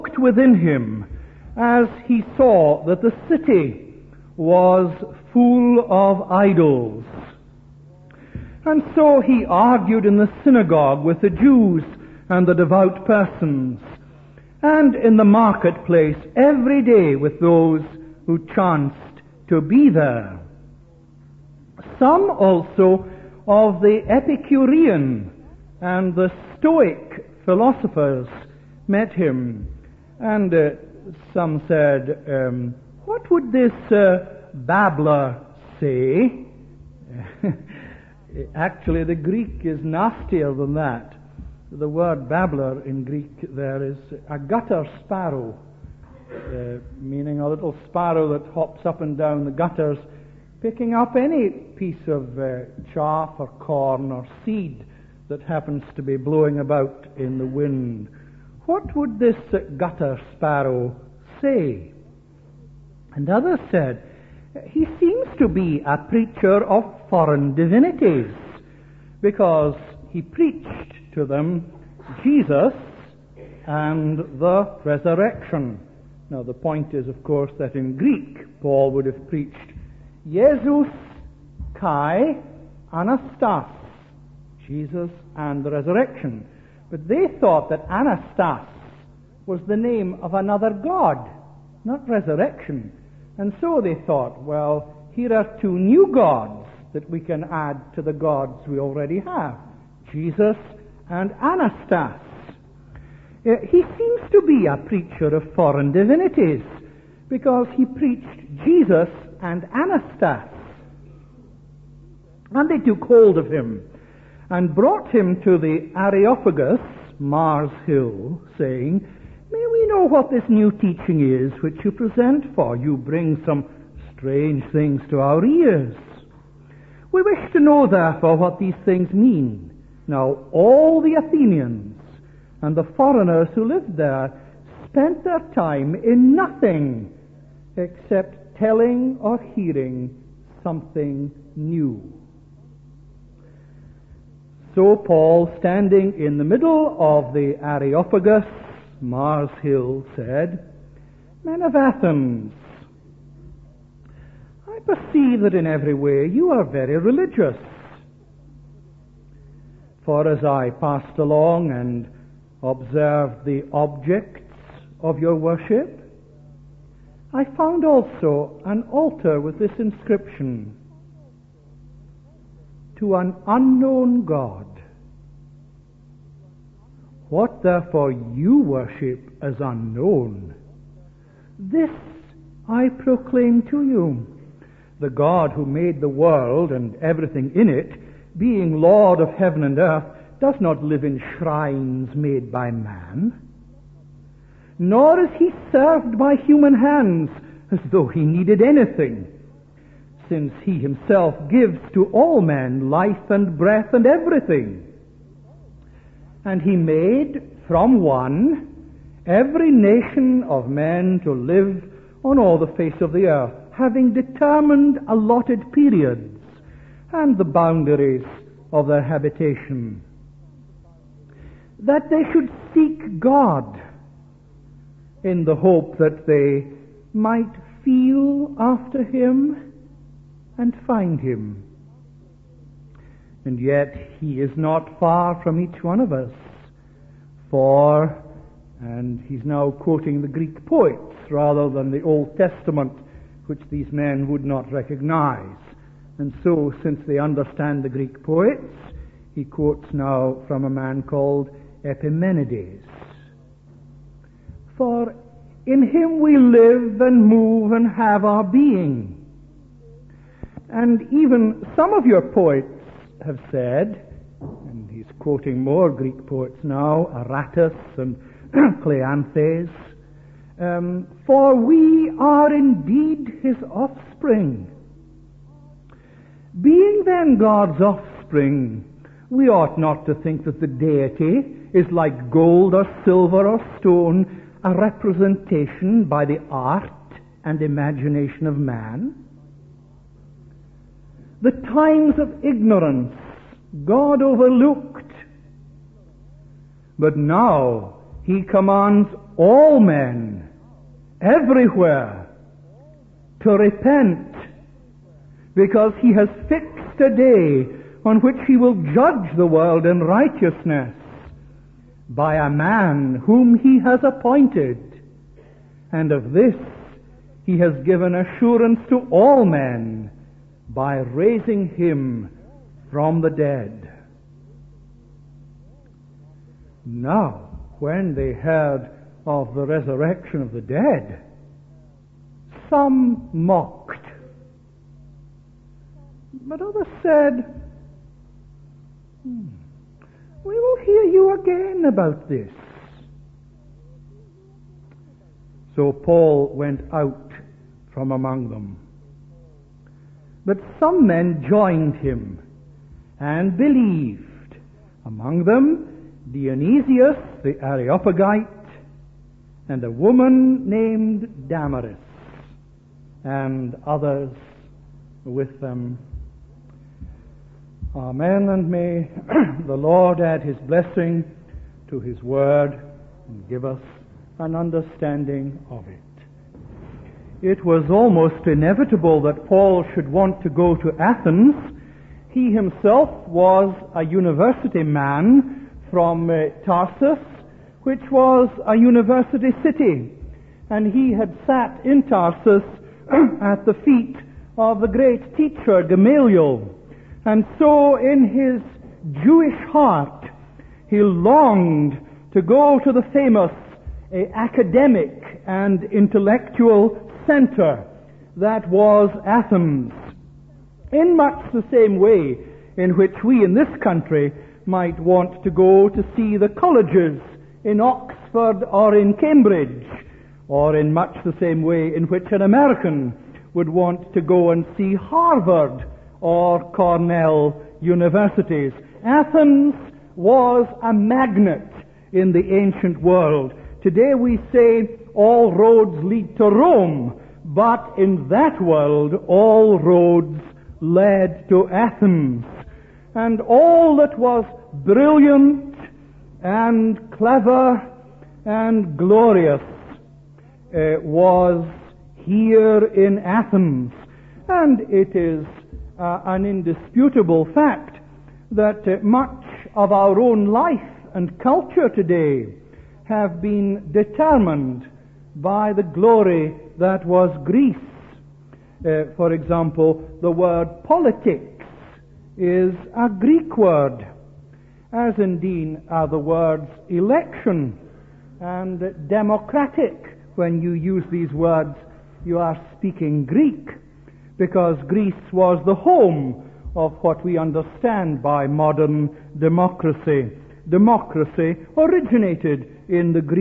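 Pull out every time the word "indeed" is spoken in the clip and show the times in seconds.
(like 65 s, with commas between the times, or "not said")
272 s, 475 s.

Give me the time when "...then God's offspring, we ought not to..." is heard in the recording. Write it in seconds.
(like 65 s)
277 s.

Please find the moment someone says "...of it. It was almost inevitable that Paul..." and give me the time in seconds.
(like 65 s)
375 s.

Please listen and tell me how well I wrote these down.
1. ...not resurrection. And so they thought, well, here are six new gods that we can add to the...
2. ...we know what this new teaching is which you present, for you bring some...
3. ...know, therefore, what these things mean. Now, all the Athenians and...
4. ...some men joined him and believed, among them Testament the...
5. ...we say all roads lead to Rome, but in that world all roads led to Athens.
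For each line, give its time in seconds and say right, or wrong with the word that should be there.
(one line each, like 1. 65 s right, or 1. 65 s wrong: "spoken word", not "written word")
1. 91 s wrong: "two", not "six"
2. 119 s right
3. 127 s right
4. 350 s wrong: "Dionysius", not "Testament"
5. 434 s right.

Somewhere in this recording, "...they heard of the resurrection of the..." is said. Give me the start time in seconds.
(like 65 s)
328 s.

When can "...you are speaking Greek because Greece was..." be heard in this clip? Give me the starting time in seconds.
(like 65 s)
482 s.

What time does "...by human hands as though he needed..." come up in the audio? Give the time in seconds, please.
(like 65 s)
196 s.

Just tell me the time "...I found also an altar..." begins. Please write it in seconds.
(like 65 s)
167 s.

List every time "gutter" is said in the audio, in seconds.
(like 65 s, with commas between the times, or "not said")
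44 s, 49 s, 59 s.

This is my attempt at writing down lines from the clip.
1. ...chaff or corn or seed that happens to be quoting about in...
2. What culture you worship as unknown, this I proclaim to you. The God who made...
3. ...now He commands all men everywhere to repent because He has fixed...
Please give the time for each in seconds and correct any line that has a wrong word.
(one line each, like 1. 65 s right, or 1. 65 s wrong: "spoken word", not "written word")
1. 52 s wrong: "blowing", not "quoting"
2. 177 s wrong: "therefore", not "culture"
3. 297 s right.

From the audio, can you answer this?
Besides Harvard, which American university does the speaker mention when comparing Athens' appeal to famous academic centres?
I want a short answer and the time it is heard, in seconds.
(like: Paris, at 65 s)
Cornell, at 426 s.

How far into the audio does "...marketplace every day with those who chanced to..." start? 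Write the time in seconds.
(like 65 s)
15 s.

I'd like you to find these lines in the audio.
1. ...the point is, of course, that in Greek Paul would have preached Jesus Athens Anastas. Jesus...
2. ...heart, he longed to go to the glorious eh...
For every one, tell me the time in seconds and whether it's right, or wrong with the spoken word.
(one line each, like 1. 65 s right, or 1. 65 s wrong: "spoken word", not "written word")
1. 76 s wrong: "Kai", not "Athens"
2. 399 s wrong: "famous", not "glorious".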